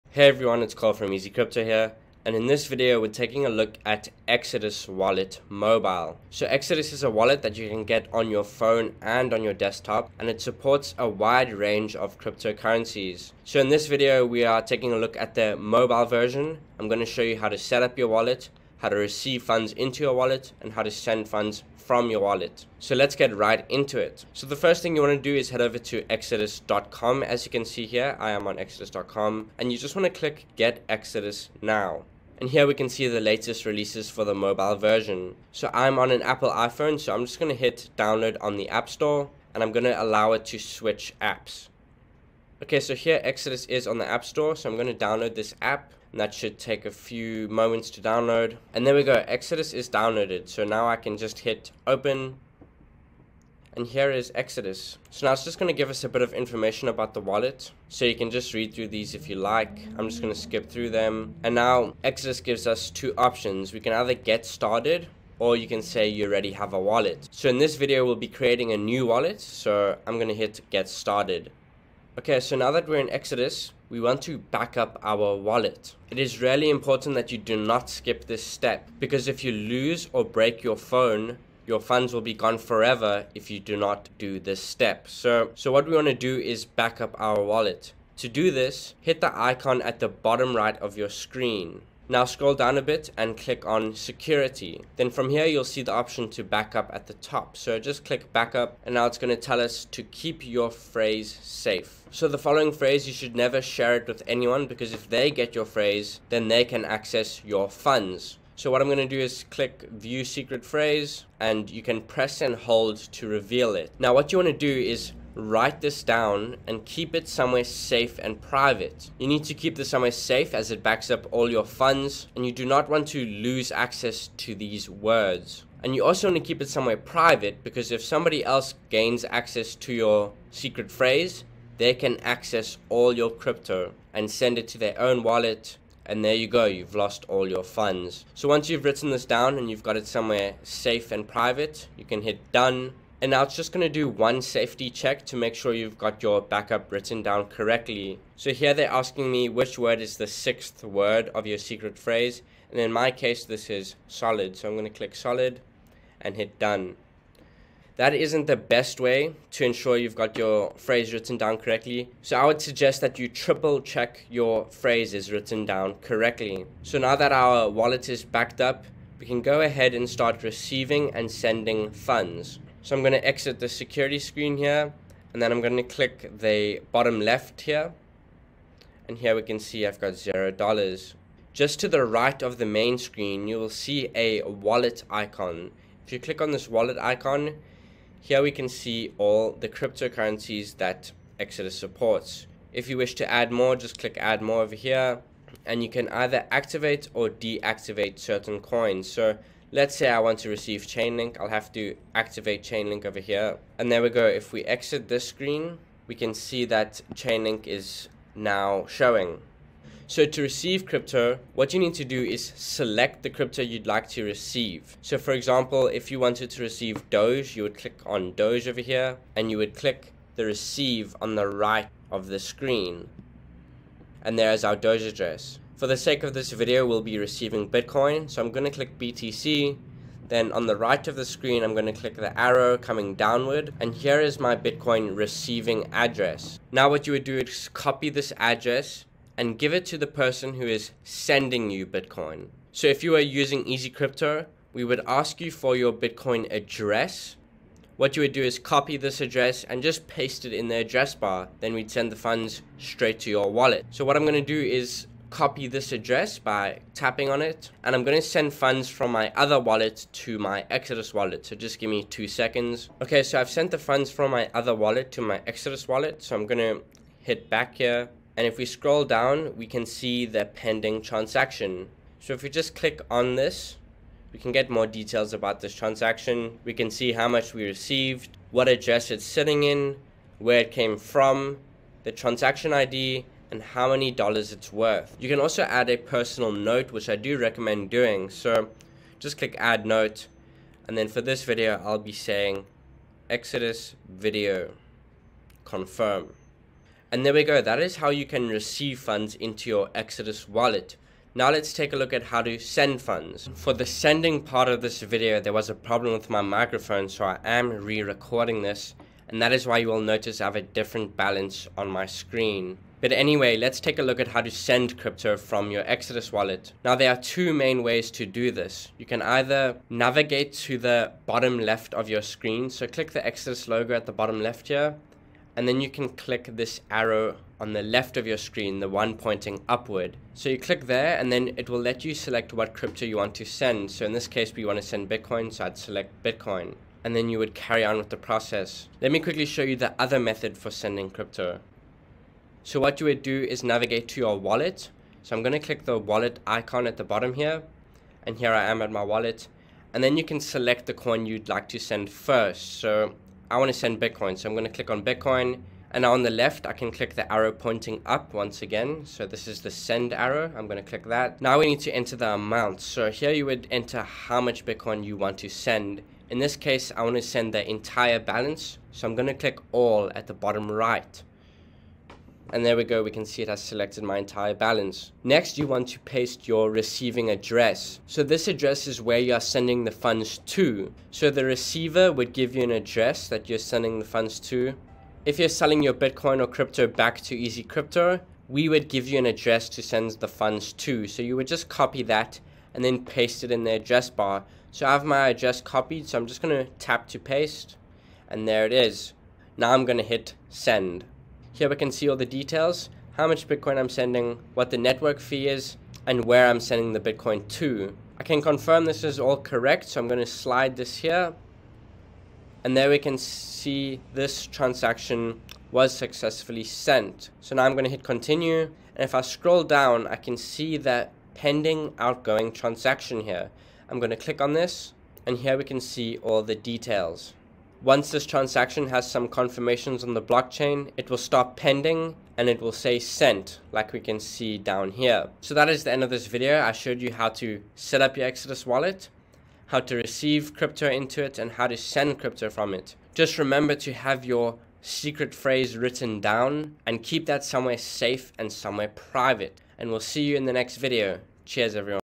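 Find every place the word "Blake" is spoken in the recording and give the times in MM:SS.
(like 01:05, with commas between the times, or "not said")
not said.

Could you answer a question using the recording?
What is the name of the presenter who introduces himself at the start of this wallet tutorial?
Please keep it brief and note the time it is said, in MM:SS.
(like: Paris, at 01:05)
Carl, at 00:00.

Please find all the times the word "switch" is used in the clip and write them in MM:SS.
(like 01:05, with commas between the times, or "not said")
00:40.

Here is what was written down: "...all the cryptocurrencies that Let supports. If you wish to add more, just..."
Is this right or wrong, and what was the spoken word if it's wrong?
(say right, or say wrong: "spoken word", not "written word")
wrong: "Exodus", not "Let".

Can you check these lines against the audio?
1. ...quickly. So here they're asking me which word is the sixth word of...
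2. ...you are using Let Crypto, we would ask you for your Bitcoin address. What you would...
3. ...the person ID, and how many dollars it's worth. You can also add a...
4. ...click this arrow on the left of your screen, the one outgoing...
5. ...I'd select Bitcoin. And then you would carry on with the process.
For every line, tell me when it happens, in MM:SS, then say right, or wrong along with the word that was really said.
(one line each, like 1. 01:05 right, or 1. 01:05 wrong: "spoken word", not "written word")
1. 02:27 wrong: "correctly", not "quickly"
2. 04:03 wrong: "Easy", not "Let"
3. 04:42 wrong: "transaction", not "person"
4. 05:26 wrong: "pointing", not "outgoing"
5. 05:35 right.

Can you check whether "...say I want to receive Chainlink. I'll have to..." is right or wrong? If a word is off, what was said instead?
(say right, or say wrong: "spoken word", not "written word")
right.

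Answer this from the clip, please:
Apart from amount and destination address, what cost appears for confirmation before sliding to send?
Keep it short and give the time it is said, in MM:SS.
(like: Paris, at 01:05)
network fee, at 06:44.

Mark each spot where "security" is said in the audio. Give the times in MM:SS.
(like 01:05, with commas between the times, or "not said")
01:33, 02:53.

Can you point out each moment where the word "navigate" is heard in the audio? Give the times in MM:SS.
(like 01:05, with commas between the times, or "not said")
05:19, 05:43.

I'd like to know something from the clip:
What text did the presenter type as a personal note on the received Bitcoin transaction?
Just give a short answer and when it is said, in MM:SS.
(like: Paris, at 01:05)
Exodus video confirm, at 04:53.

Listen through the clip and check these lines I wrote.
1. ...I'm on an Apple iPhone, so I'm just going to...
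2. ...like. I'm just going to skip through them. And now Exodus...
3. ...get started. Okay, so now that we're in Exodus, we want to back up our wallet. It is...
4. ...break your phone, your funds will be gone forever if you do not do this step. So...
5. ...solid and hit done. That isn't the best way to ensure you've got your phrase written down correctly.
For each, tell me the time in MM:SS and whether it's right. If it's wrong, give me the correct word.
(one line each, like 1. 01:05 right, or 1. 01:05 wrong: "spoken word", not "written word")
1. 00:35 right
2. 00:59 right
3. 01:10 right
4. 01:20 right
5. 02:35 right.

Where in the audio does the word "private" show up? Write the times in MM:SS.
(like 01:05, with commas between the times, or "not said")
01:58, 02:06, 02:21, 07:28.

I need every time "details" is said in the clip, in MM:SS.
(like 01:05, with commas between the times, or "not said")
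04:34, 06:42, 07:06.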